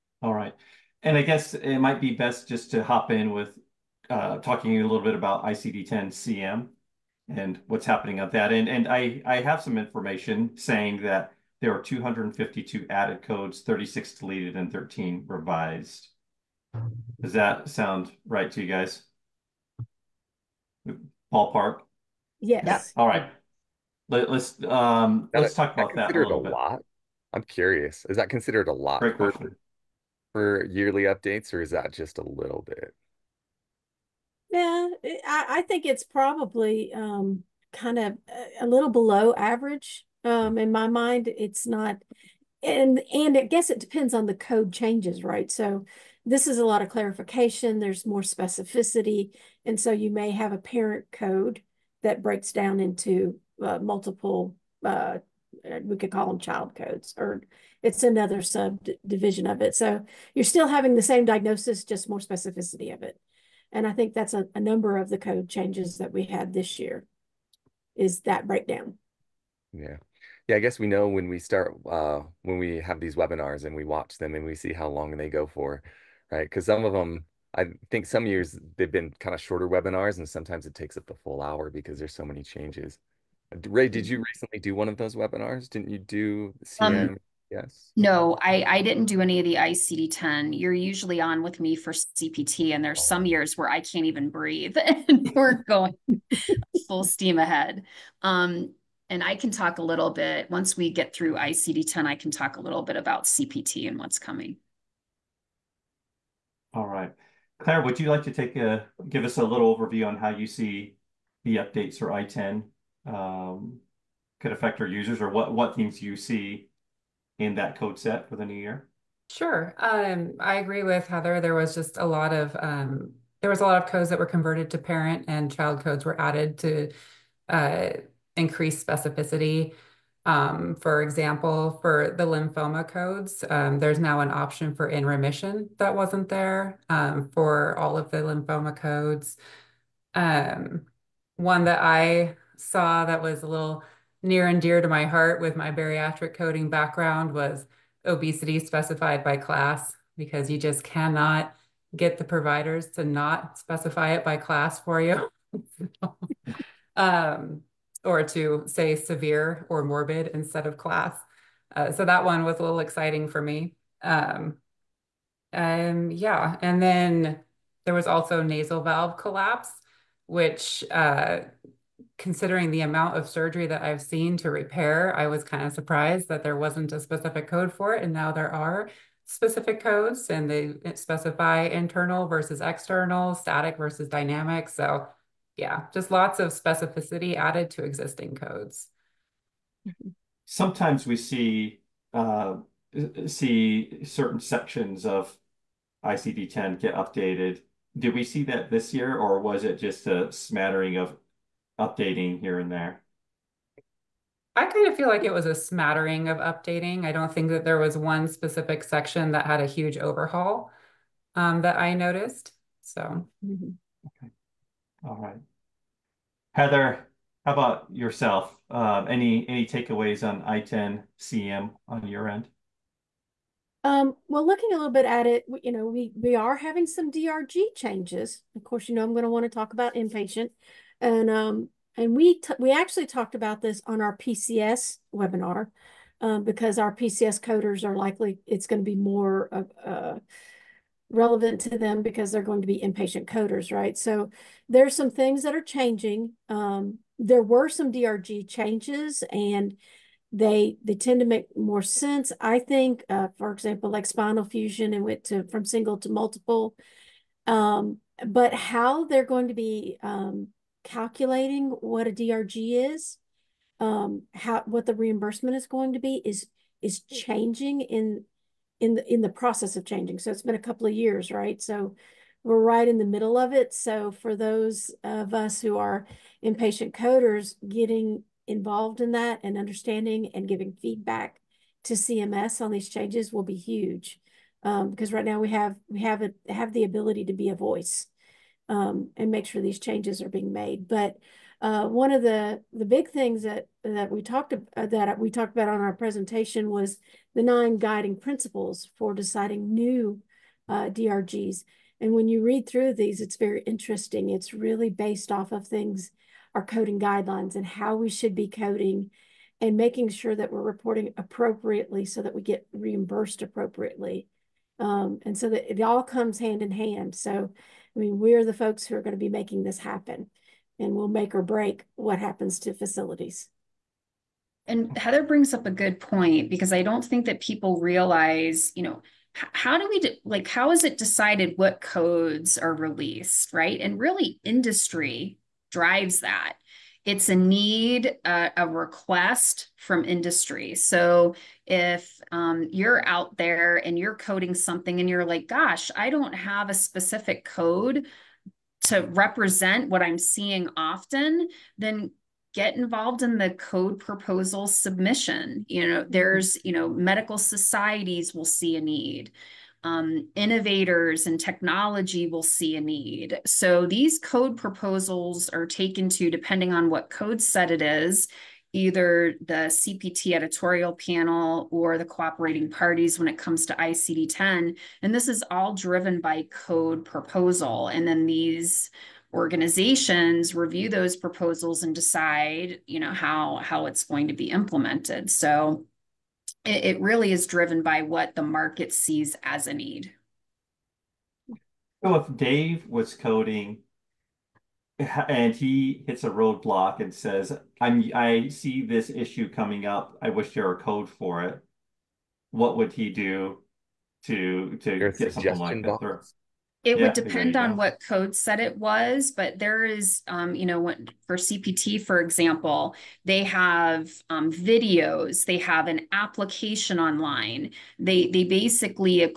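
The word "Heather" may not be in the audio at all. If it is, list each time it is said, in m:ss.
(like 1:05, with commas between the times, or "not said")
2:01, 3:36, 5:24.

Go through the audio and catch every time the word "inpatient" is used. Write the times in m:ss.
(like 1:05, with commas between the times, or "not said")
3:49, 4:02, 4:36.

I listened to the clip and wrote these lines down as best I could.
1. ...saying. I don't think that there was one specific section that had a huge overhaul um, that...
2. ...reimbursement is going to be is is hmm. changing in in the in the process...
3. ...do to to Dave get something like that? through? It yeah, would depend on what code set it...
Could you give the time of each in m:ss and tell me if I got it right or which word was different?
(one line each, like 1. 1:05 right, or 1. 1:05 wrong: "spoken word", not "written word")
1. 3:26 wrong: "updating", not "saying"
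2. 4:24 right
3. 6:43 wrong: "Your", not "Dave".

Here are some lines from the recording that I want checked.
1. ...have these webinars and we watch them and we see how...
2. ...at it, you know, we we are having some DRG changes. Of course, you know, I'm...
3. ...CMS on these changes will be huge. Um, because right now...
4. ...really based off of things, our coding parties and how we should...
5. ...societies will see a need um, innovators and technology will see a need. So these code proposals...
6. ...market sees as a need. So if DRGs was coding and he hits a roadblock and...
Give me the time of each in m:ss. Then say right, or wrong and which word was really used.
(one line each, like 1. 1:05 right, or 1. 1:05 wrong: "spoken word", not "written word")
1. 1:12 right
2. 3:45 right
3. 4:41 right
4. 5:04 wrong: "guidelines", not "parties"
5. 5:57 right
6. 6:28 wrong: "Dave", not "DRGs".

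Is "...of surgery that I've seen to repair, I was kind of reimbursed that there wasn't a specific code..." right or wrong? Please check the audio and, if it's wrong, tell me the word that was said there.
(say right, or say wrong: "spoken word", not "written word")
wrong: "surprised", not "reimbursed".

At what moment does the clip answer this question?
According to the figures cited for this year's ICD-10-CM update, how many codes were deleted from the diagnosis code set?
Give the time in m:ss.
0:13.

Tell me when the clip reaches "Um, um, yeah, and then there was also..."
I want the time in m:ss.
2:44.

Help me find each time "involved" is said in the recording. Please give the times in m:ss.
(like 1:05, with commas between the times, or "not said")
4:38, 5:52.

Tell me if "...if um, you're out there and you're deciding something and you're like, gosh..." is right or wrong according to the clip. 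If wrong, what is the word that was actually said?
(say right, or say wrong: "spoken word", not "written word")
wrong: "coding", not "deciding".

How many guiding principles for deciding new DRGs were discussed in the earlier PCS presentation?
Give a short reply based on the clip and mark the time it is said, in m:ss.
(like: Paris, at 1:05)
9, at 4:57.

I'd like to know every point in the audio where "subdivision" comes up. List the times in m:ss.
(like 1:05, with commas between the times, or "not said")
0:58.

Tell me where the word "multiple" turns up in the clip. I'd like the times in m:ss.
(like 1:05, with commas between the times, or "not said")
0:53, 4:16.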